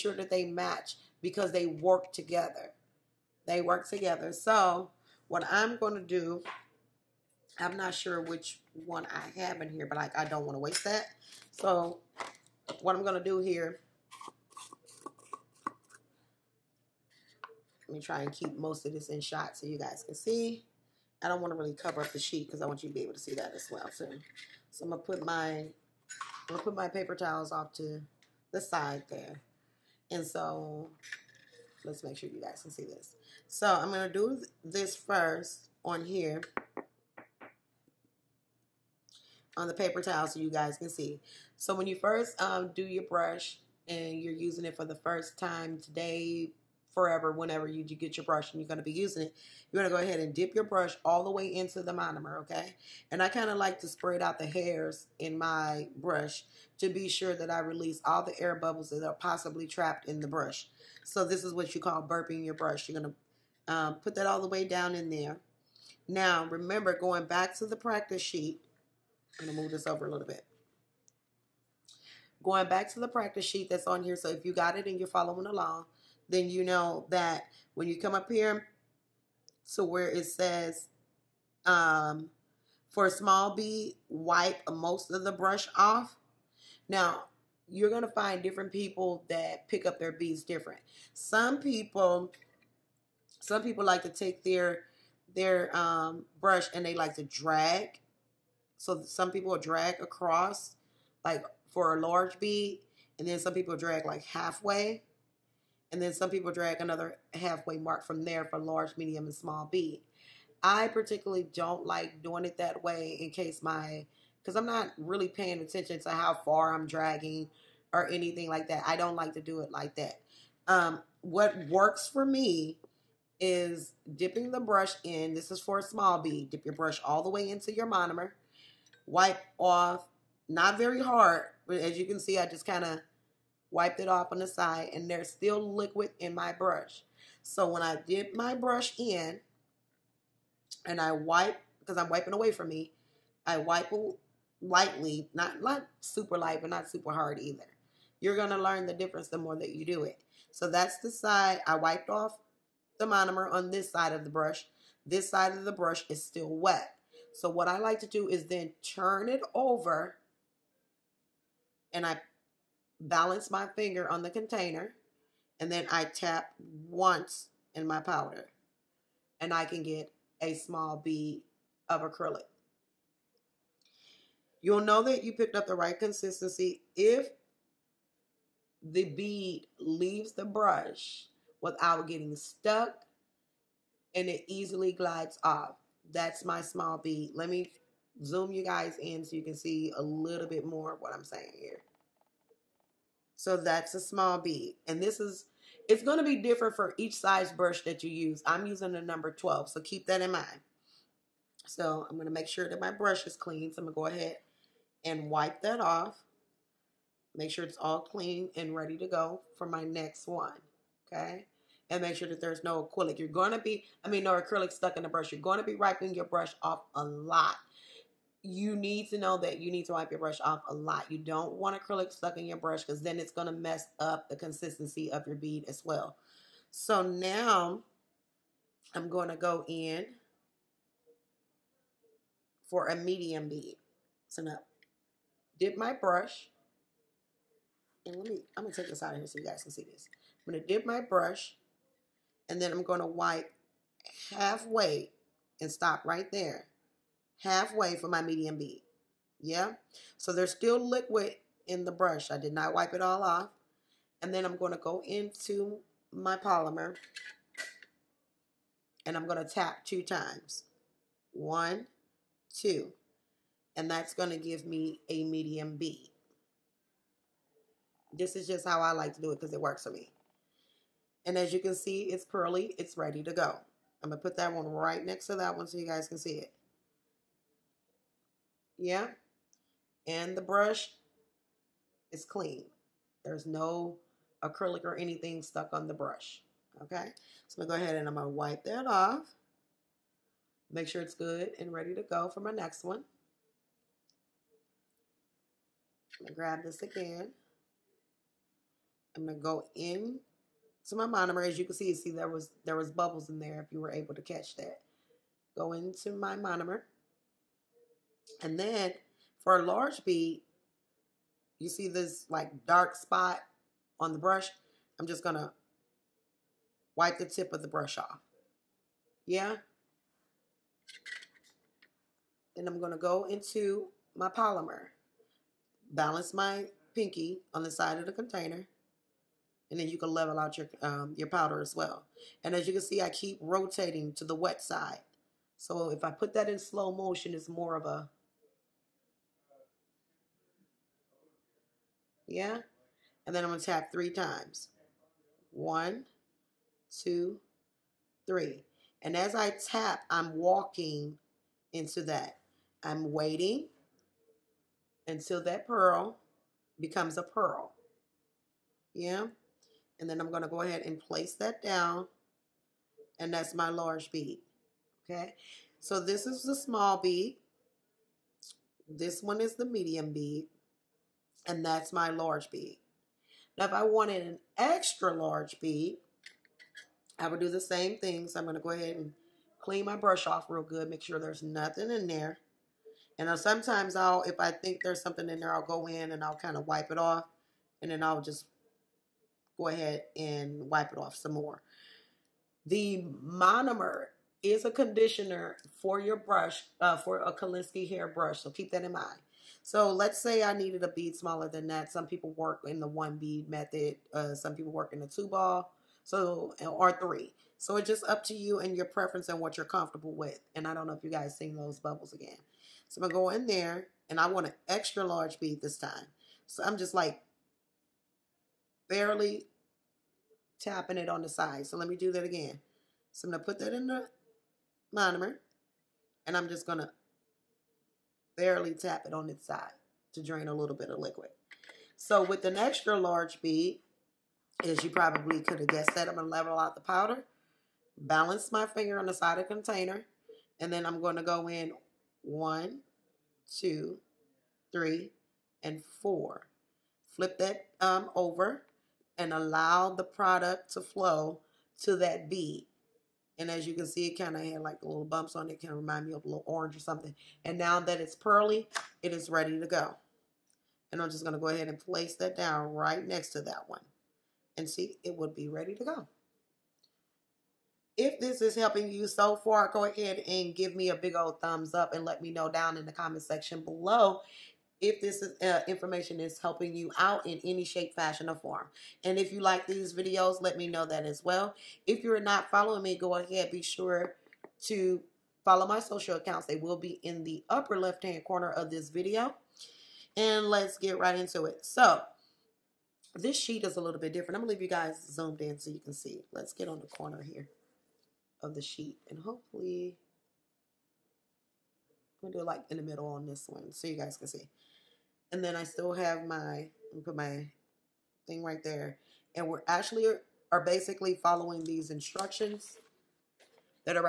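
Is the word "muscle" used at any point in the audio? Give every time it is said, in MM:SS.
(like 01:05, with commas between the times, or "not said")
not said.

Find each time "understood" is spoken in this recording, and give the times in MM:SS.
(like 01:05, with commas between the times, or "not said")
not said.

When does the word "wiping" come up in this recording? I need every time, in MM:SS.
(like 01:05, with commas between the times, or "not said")
02:22, 03:35.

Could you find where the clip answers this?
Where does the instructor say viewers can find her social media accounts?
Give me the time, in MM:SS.
08:07.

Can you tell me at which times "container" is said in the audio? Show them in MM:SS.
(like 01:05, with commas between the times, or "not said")
02:44, 05:28, 07:19.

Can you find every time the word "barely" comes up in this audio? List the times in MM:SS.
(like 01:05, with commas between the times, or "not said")
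06:58, 07:08.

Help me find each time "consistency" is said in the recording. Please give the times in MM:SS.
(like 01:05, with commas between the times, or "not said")
02:55, 03:44.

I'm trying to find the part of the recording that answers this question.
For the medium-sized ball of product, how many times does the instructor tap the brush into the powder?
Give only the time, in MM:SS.
04:19.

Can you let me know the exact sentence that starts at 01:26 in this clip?
Now, you're going to find different people that pick up their bees different.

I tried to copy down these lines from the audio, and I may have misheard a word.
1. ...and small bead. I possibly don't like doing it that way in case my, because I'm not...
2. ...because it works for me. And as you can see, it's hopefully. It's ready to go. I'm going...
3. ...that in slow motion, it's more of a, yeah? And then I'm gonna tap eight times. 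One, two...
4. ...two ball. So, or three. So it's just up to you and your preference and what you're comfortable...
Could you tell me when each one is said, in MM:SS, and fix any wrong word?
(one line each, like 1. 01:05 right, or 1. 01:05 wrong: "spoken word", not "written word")
1. 01:49 wrong: "particularly", not "possibly"
2. 04:29 wrong: "pearly", not "hopefully"
3. 05:36 wrong: "three", not "eight"
4. 06:45 right.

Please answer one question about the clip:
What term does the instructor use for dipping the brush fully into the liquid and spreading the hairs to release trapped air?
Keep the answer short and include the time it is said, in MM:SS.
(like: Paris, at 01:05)
burping your brush, at 01:02.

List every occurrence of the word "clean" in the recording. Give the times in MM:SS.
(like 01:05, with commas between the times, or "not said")
03:23, 03:27, 04:42, 06:19.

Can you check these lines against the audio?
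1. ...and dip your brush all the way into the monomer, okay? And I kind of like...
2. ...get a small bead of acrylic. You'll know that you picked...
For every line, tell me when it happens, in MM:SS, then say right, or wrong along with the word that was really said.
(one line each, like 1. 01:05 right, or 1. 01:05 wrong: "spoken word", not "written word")
1. 00:50 right
2. 02:49 right.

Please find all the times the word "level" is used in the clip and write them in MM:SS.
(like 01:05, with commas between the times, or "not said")
05:30, 07:16.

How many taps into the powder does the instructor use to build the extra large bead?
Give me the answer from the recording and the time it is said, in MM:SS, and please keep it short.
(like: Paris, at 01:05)
4, at 07:26.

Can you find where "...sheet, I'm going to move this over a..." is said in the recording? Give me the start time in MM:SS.
01:08.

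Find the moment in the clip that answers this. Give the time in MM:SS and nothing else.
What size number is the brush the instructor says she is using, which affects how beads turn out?
03:19.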